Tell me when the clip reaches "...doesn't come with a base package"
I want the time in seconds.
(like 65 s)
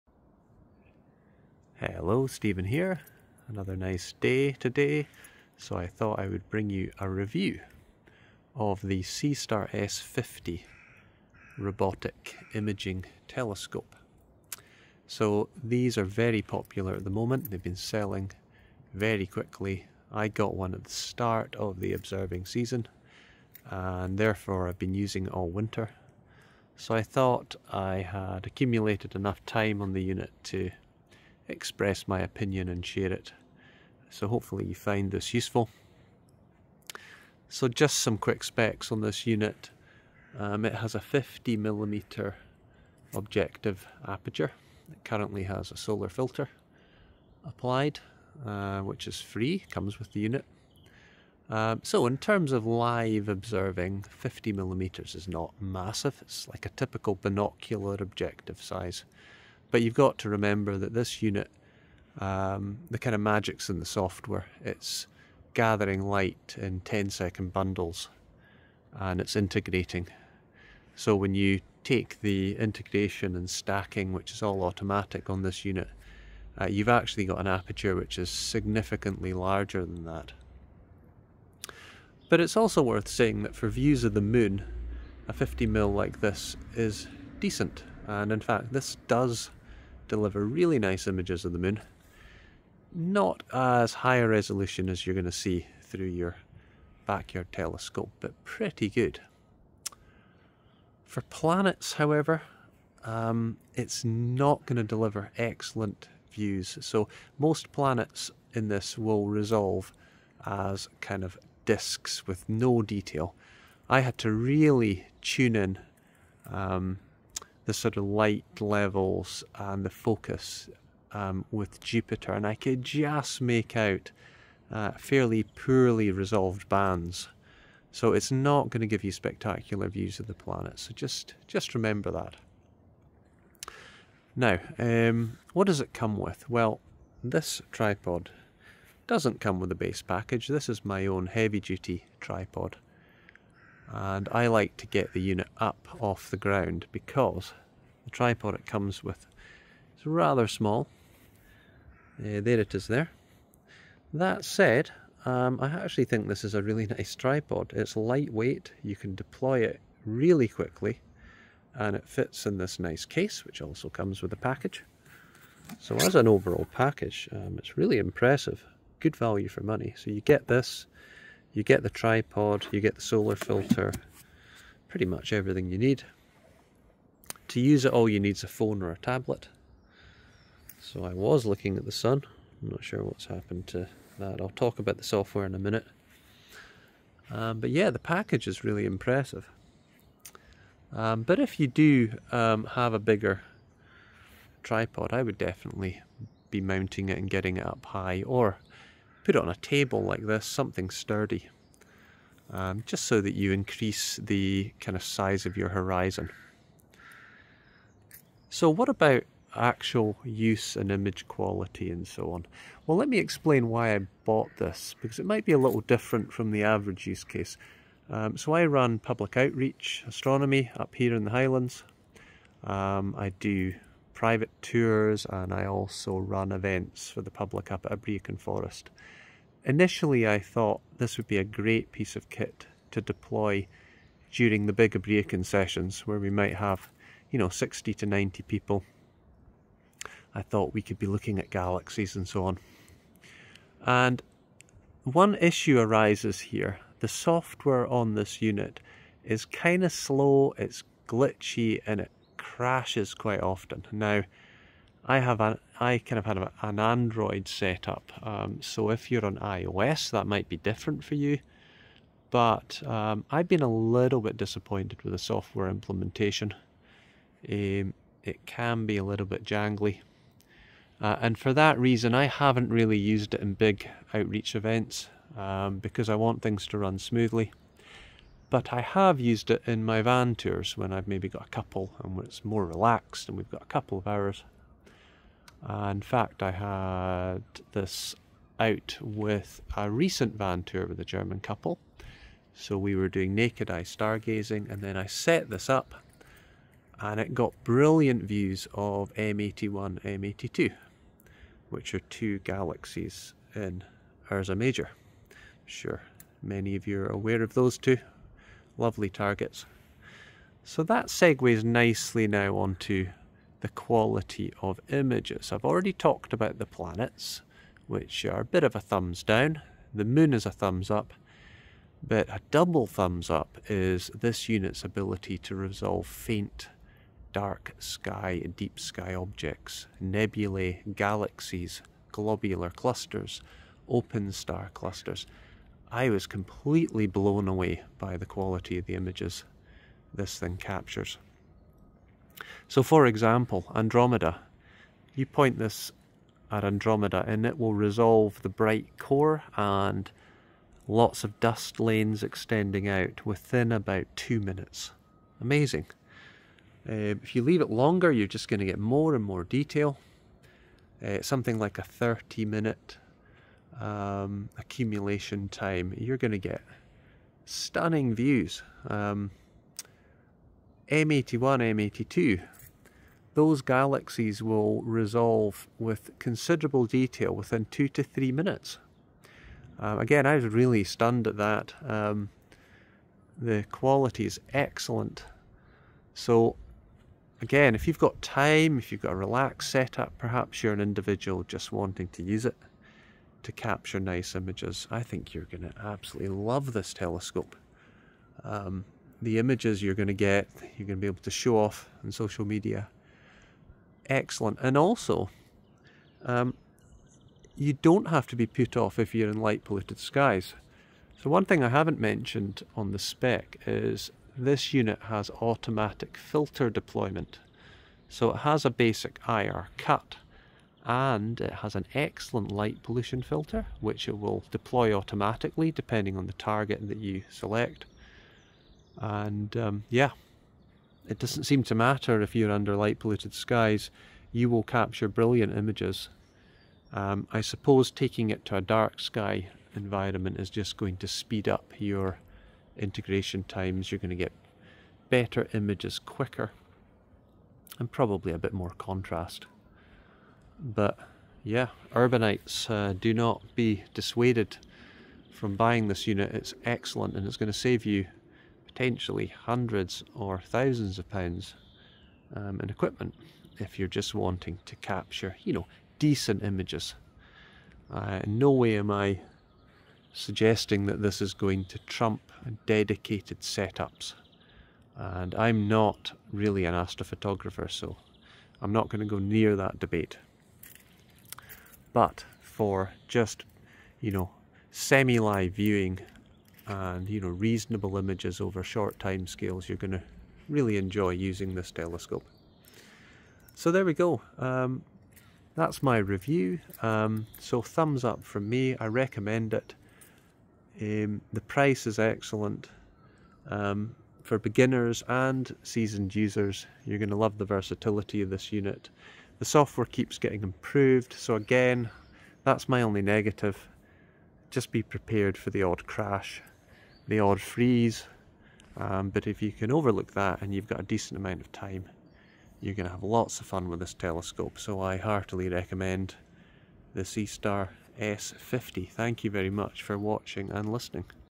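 139 s.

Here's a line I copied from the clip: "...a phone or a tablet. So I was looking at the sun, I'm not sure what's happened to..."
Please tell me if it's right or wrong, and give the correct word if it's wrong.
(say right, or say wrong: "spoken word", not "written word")
right.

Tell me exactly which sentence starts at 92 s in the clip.
Not as high a resolution as you're going to see through your backyard telescope, but pretty good.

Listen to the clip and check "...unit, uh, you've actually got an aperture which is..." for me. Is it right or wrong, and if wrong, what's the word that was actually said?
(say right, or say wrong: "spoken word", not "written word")
right.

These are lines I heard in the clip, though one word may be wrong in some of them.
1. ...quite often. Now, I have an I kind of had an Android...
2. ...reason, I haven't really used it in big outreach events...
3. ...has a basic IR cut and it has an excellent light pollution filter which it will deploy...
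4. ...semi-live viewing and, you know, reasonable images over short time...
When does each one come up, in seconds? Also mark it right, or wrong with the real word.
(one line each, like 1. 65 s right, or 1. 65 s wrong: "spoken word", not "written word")
1. 253 s right
2. 271 s right
3. 418 s right
4. 484 s right.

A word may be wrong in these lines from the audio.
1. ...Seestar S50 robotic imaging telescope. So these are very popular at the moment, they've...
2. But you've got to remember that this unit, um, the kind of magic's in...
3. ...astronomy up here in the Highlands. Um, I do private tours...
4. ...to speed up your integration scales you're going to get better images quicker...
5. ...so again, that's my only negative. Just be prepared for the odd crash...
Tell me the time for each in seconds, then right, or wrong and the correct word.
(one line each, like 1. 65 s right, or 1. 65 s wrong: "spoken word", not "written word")
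1. 9 s right
2. 59 s right
3. 220 s right
4. 440 s wrong: "times", not "scales"
5. 511 s right.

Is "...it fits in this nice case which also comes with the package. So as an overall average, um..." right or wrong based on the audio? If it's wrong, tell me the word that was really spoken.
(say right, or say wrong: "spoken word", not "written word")
wrong: "package", not "average".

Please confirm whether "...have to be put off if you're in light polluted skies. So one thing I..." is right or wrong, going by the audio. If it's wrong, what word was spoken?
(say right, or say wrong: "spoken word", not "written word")
right.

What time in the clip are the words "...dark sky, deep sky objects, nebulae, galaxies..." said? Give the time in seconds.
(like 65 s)
327 s.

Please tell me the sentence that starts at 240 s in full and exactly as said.
I thought we could be looking at galaxies and so on.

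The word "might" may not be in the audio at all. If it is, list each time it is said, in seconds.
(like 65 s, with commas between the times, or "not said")
215 s, 236 s, 260 s.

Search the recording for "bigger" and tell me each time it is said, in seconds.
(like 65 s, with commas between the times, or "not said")
192 s.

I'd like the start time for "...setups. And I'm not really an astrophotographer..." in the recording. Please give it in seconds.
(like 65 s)
473 s.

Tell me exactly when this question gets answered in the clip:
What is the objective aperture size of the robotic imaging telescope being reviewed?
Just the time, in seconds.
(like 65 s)
40 s.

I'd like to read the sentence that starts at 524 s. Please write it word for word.
So I heartily recommend the Seestar S50.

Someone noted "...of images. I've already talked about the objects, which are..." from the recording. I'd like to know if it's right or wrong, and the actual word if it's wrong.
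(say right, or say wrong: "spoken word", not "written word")
wrong: "planets", not "objects".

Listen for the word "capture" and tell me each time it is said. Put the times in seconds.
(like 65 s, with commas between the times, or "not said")
340 s, 393 s, 434 s, 464 s.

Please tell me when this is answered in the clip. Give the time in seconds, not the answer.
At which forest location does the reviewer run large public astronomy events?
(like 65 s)
227 s.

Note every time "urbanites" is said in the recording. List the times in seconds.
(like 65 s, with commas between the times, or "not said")
451 s.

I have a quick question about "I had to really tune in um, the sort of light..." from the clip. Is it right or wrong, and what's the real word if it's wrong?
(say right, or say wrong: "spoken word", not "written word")
right.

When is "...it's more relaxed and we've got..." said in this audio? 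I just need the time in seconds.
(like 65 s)
282 s.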